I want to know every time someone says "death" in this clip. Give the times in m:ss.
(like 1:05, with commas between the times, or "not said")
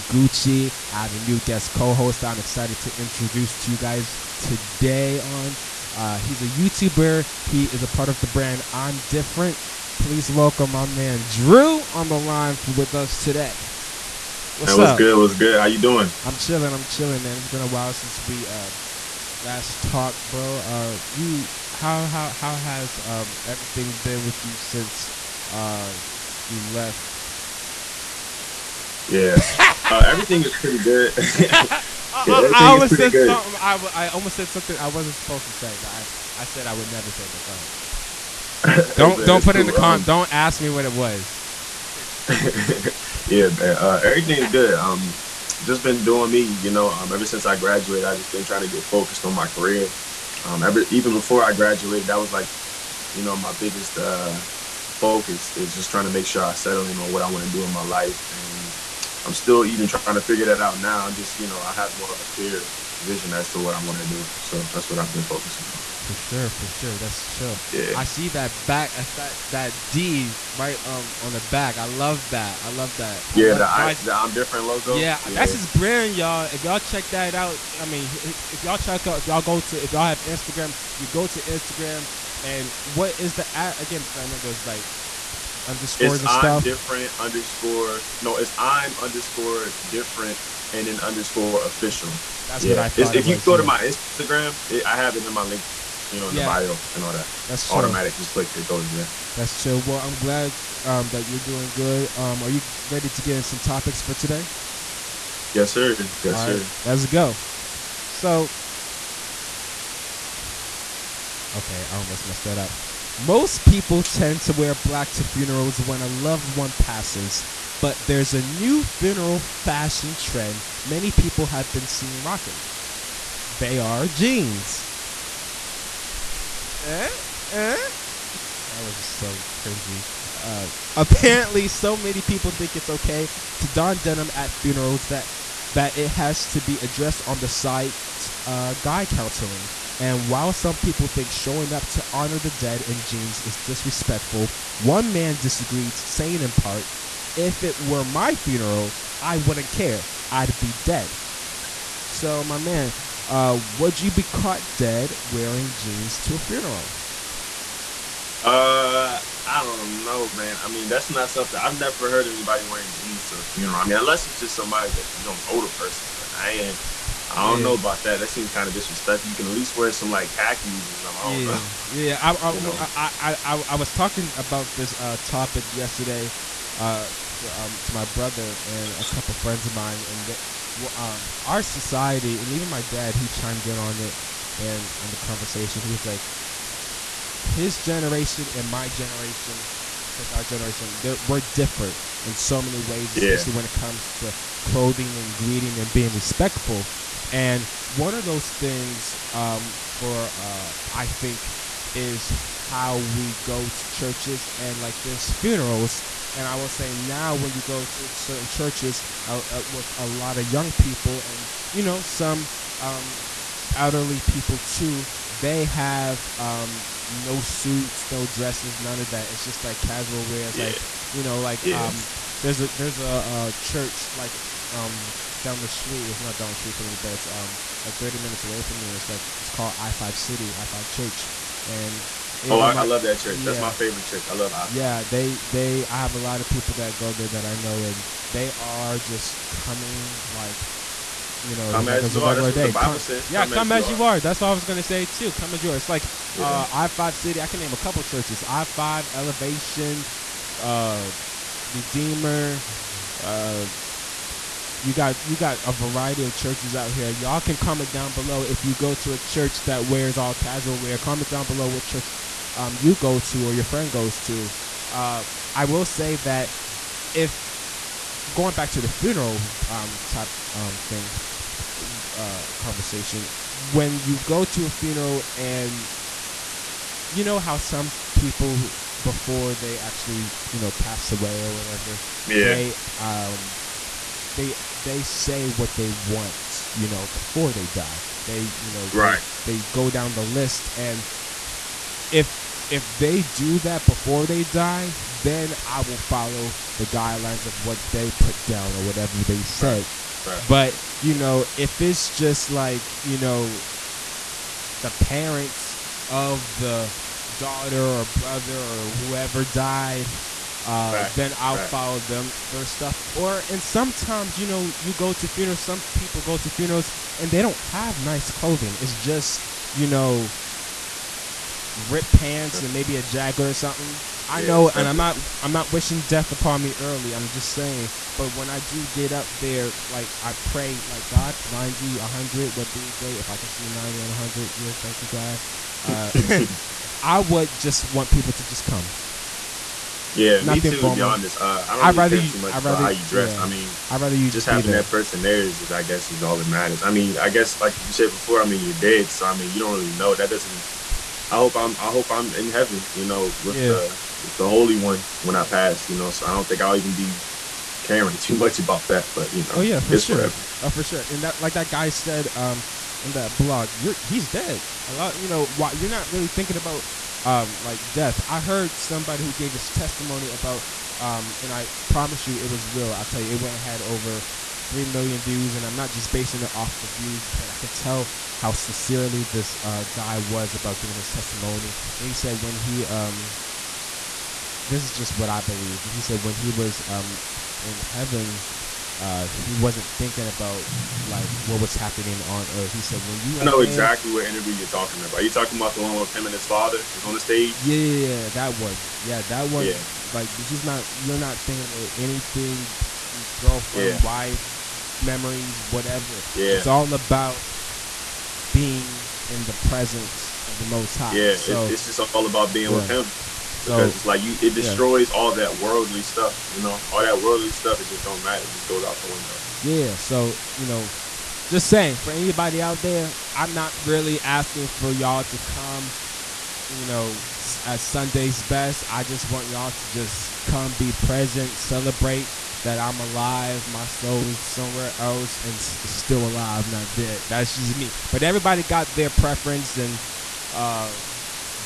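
5:26, 6:07.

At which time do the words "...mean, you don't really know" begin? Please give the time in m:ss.
5:49.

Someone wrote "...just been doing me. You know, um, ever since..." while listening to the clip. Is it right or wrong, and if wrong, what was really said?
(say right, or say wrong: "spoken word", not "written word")
right.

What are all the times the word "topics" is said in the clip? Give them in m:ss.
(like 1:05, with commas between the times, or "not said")
1:43, 2:55.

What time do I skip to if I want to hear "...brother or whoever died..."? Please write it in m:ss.
5:08.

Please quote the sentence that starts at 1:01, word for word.
I'm just, you know, I have more of a clear vision as to what I want to do.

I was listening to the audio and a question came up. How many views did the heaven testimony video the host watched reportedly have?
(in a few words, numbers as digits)
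3 million.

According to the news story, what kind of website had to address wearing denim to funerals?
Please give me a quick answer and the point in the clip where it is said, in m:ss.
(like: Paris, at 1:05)
guy counseling, at 2:18.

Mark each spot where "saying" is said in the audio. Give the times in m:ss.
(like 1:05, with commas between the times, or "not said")
2:25, 5:27, 7:01.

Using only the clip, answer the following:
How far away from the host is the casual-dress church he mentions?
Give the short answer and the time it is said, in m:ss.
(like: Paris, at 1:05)
30 minutes, at 3:47.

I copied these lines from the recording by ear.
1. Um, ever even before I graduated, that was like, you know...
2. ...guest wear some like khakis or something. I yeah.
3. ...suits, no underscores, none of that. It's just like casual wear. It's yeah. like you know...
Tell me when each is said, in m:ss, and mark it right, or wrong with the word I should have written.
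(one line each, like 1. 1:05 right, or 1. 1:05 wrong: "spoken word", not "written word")
1. 0:50 right
2. 2:49 wrong: "least", not "guest"
3. 3:37 wrong: "dresses", not "underscores".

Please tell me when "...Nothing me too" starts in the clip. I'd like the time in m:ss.
5:40.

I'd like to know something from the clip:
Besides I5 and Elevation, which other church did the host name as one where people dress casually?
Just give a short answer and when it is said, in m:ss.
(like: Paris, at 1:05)
Redeemer, at 4:11.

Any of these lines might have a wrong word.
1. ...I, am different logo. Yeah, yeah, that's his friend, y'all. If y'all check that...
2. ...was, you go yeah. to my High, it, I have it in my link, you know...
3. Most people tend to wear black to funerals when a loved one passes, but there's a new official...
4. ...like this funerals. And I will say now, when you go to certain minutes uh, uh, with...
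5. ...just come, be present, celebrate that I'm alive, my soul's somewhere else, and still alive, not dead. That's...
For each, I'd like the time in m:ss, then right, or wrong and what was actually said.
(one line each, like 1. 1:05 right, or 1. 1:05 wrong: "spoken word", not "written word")
1. 1:14 wrong: "brand", not "friend"
2. 1:33 wrong: "Instagram", not "High"
3. 1:53 wrong: "funeral", not "official"
4. 3:24 wrong: "churches", not "minutes"
5. 7:09 right.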